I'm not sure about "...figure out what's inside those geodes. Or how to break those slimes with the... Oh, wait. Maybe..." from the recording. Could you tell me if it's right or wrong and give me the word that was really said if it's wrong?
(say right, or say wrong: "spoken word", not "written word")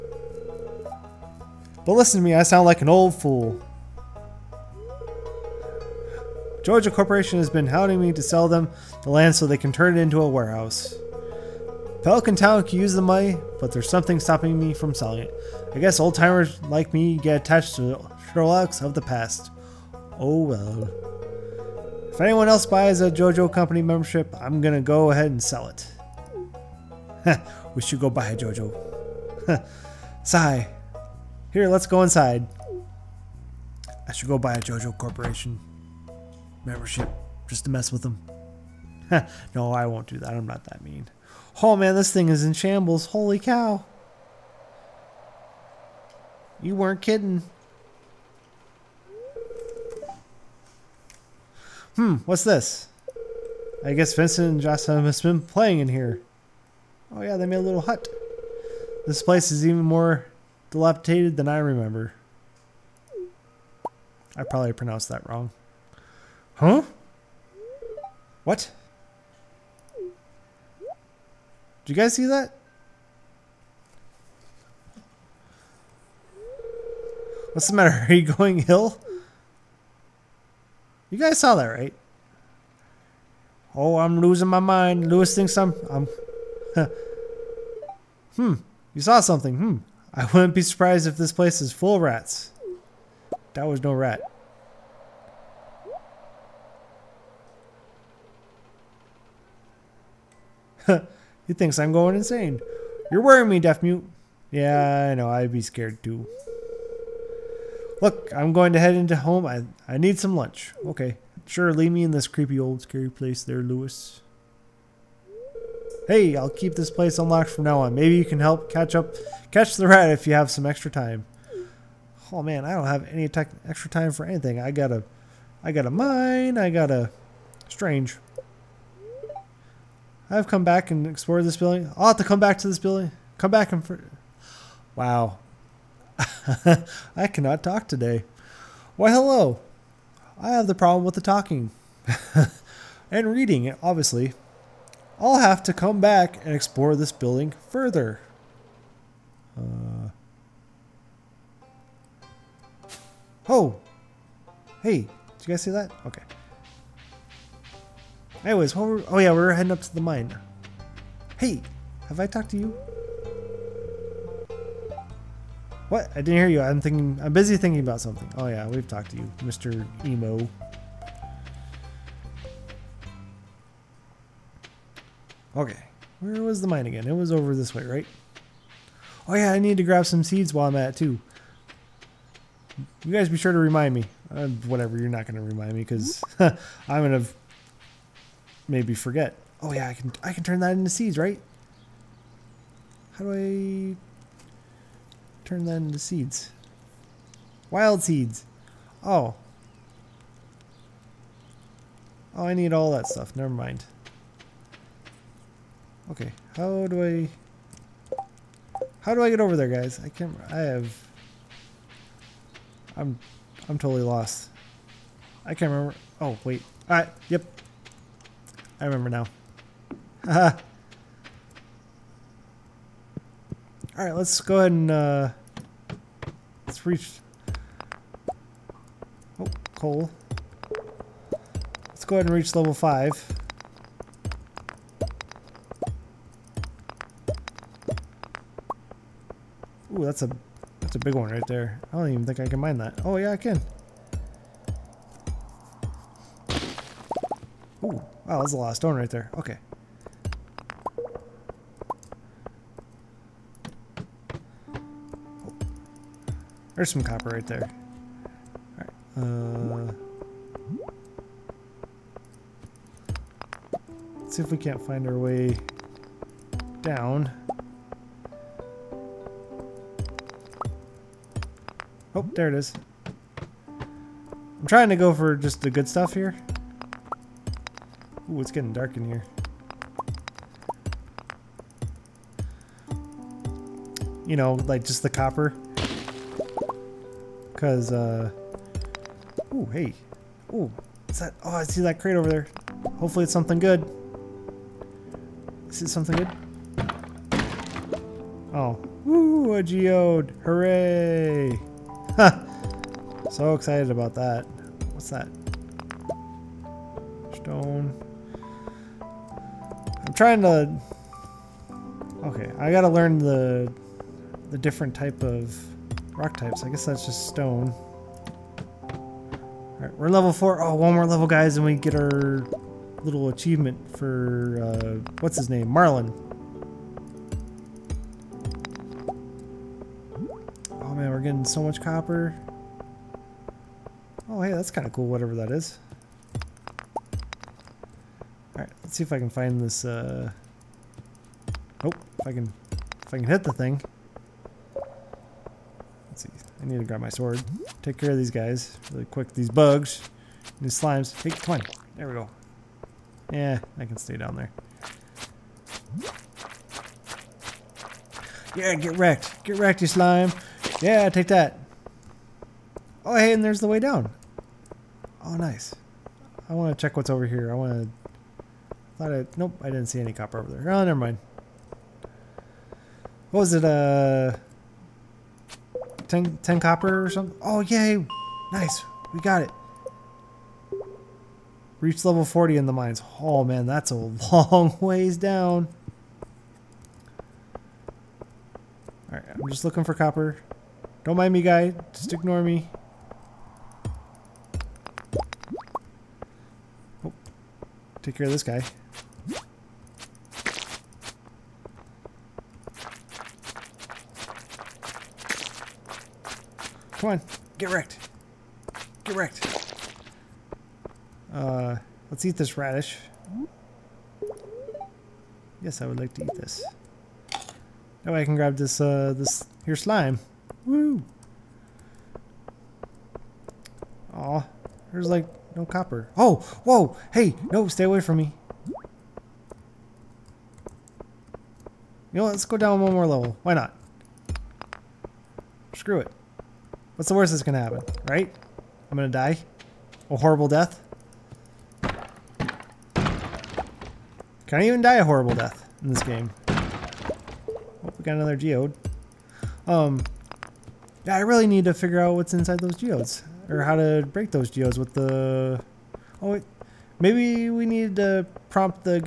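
wrong: "geodes", not "slimes".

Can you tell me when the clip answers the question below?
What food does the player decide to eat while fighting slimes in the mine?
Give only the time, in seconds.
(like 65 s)
412 s.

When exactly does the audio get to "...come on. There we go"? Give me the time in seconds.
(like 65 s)
351 s.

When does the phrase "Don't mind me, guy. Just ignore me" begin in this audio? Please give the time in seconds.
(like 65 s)
391 s.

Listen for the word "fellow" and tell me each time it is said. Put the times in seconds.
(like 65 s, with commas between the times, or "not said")
not said.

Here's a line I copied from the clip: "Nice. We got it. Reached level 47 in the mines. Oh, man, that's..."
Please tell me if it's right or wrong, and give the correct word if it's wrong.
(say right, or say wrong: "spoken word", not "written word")
wrong: "40", not "47".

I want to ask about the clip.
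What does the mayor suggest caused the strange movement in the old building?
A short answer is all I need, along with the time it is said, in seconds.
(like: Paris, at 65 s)
rats, at 92 s.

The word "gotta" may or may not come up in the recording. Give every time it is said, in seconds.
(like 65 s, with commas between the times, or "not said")
312 s.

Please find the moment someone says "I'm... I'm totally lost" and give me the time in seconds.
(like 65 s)
212 s.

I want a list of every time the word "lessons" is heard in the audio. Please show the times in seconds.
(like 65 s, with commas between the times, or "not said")
not said.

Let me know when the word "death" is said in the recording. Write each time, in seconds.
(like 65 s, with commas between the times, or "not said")
440 s, 445 s.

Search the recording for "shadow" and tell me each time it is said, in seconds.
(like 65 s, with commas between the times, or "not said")
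not said.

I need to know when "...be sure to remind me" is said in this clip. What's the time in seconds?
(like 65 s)
183 s.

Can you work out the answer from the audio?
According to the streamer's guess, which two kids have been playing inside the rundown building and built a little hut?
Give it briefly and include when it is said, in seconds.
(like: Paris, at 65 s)
Vincent and Jocelyn, at 54 s.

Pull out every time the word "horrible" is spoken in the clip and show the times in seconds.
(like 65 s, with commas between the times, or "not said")
440 s, 445 s.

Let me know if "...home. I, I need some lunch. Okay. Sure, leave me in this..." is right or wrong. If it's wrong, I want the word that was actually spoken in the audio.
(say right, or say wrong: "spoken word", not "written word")
right.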